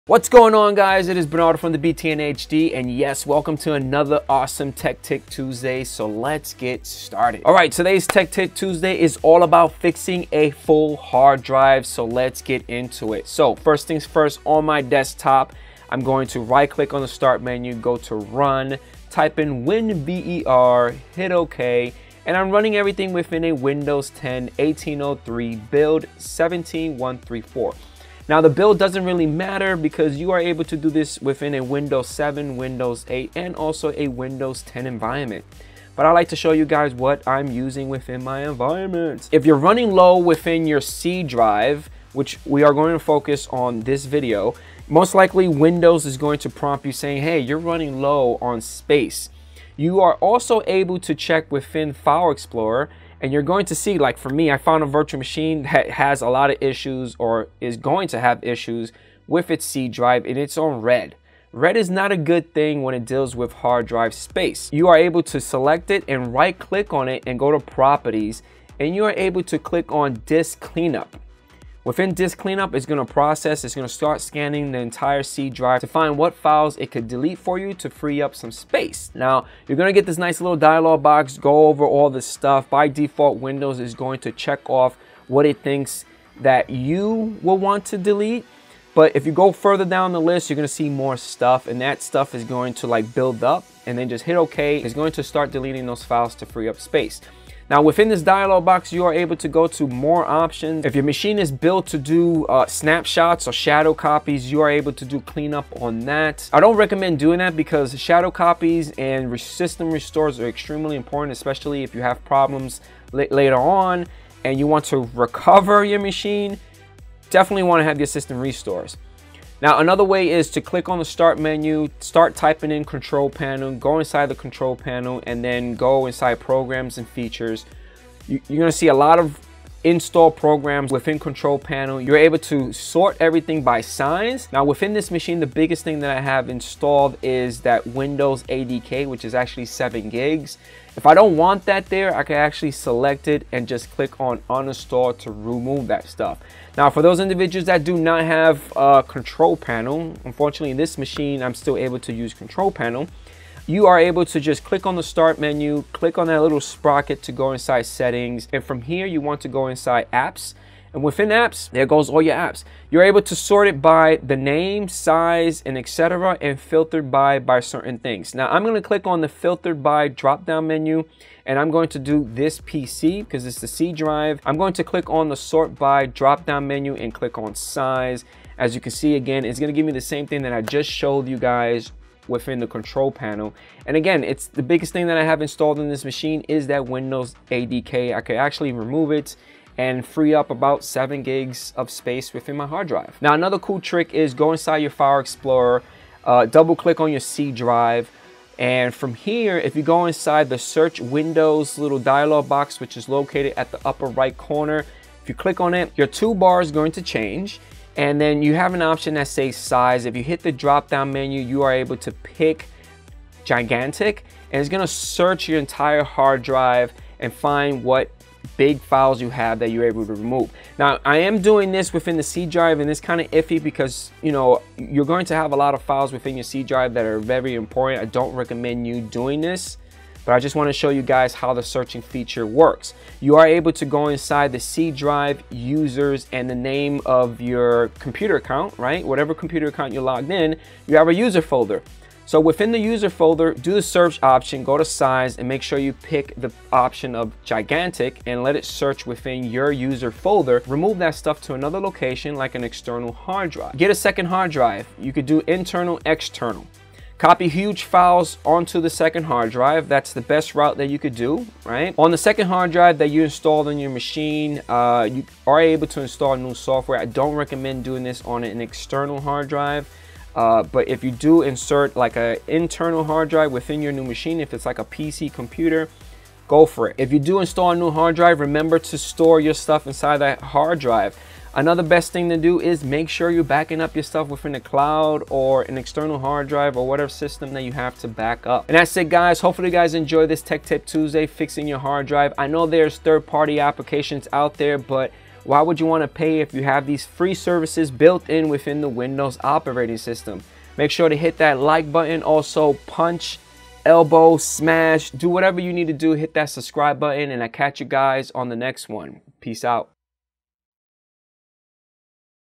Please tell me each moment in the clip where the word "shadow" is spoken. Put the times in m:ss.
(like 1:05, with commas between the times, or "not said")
1:43, 1:47.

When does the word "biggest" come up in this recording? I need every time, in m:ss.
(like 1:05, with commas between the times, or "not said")
2:15, 3:04.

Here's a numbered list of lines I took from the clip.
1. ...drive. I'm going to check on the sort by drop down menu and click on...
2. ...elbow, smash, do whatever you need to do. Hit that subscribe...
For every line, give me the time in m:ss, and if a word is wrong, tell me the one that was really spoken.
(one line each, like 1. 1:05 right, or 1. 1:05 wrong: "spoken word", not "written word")
1. 2:53 wrong: "click", not "check"
2. 5:03 right.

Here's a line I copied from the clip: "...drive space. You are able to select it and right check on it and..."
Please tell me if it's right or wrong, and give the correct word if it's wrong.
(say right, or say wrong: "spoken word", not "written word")
wrong: "click", not "check".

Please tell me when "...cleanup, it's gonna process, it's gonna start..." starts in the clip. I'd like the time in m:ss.
1:12.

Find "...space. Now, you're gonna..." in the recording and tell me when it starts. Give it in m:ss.
1:18.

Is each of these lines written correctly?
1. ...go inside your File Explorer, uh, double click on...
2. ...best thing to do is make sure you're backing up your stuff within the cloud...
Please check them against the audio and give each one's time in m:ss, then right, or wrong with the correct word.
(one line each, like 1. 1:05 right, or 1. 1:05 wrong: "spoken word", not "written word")
1. 3:14 right
2. 4:41 right.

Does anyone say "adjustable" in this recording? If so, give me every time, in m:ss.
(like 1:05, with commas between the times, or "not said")
not said.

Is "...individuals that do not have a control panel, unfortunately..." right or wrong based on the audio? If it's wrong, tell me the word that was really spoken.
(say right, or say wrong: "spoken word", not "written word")
right.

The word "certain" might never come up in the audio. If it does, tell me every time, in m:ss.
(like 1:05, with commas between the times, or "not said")
2:47.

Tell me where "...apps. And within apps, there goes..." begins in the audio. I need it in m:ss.
2:40.